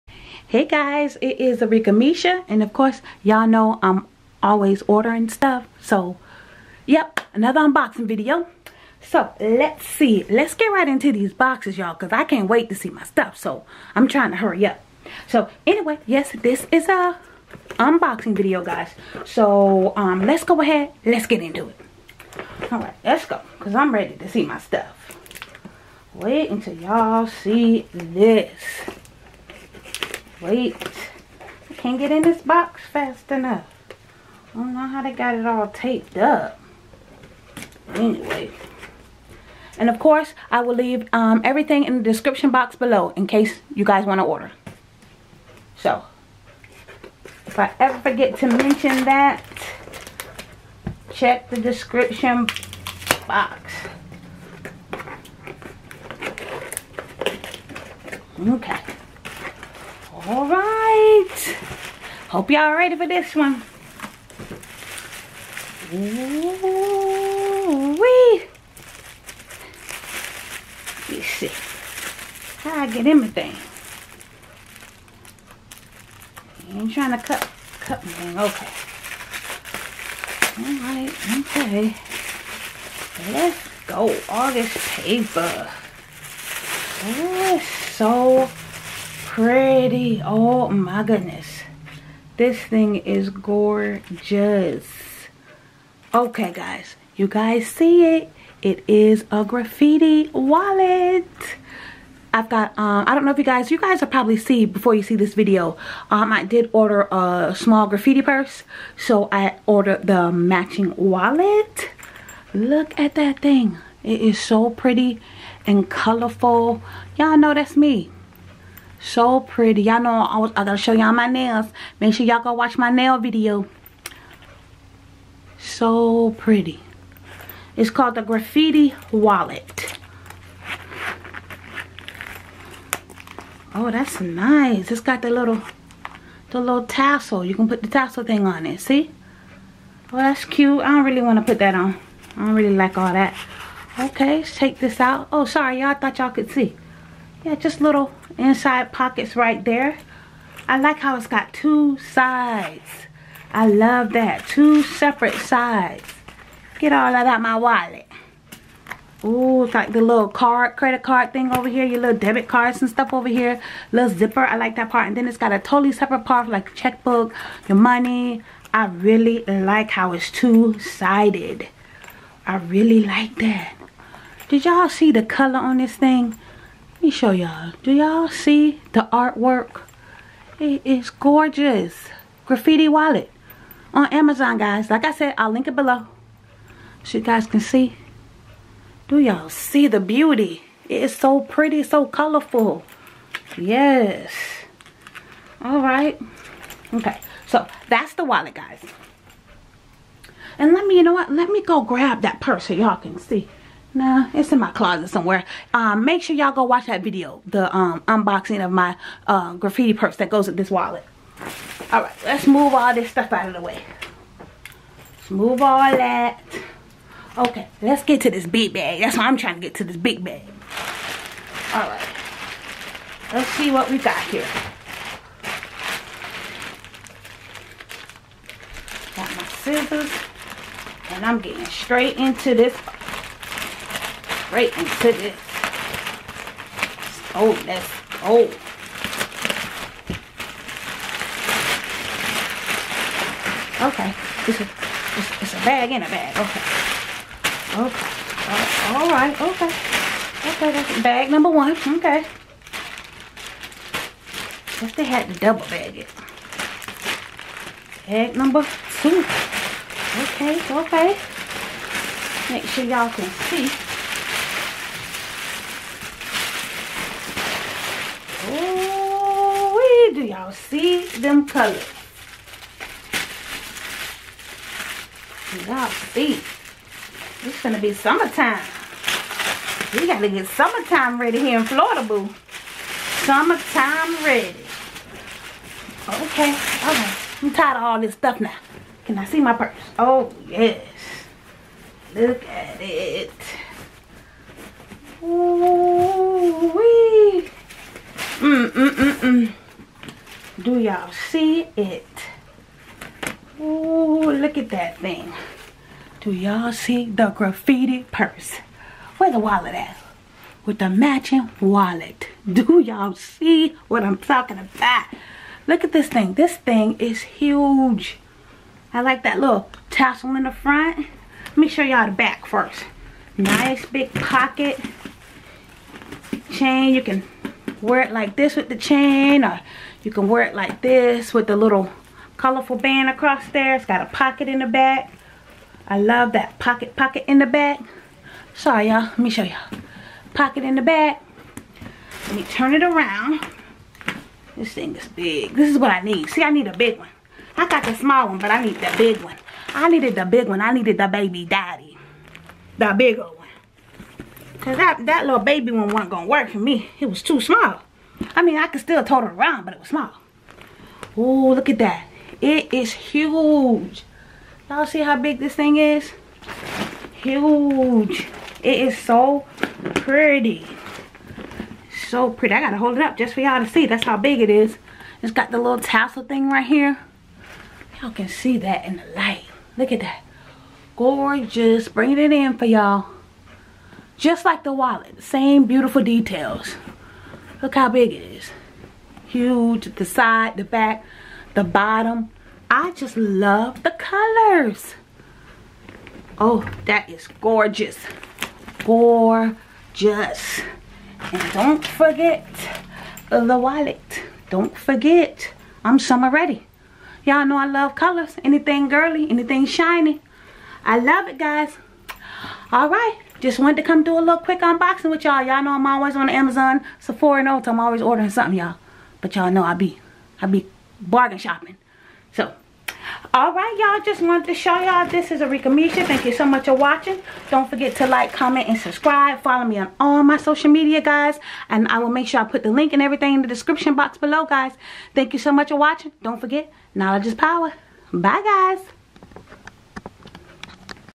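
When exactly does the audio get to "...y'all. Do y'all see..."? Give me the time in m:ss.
2:57.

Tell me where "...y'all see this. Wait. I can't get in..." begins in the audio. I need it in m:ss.
0:26.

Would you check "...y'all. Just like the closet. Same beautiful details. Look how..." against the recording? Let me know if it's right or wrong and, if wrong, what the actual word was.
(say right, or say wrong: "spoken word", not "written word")
wrong: "wallet", not "closet".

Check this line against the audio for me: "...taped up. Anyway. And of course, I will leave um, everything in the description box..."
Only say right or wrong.
right.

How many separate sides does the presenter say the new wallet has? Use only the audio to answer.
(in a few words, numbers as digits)
2.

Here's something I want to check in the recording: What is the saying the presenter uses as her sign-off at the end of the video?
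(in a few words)
knowledge is power.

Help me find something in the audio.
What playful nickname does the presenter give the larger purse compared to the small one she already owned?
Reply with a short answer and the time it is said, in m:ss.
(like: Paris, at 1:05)
the baby daddy, at 5:50.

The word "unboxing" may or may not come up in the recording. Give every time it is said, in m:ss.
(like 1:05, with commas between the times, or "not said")
0:07, 0:17, 3:28, 6:54.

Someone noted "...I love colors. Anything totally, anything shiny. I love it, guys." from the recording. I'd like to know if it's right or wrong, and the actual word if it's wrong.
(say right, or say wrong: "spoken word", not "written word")
wrong: "girly", not "totally".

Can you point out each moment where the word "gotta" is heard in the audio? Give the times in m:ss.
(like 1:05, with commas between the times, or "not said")
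2:00, 4:40, 6:12.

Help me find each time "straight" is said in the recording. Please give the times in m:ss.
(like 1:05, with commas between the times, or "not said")
3:51.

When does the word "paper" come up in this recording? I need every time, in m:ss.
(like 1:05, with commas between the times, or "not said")
1:24.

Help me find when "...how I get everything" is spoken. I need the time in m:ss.
1:12.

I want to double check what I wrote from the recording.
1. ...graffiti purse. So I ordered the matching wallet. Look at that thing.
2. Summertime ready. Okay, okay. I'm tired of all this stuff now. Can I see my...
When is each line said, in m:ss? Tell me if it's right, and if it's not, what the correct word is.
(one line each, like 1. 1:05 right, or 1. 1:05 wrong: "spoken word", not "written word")
1. 1:47 right
2. 4:43 right.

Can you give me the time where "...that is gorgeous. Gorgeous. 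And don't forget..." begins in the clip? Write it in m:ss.
6:36.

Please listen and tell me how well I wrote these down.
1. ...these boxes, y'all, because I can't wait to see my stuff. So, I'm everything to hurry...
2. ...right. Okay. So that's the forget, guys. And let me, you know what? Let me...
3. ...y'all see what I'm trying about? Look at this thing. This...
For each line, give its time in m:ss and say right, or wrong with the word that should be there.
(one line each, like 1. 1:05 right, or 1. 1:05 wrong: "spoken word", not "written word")
1. 0:11 wrong: "trying", not "everything"
2. 3:15 wrong: "wallet", not "forget"
3. 5:12 wrong: "talking", not "trying".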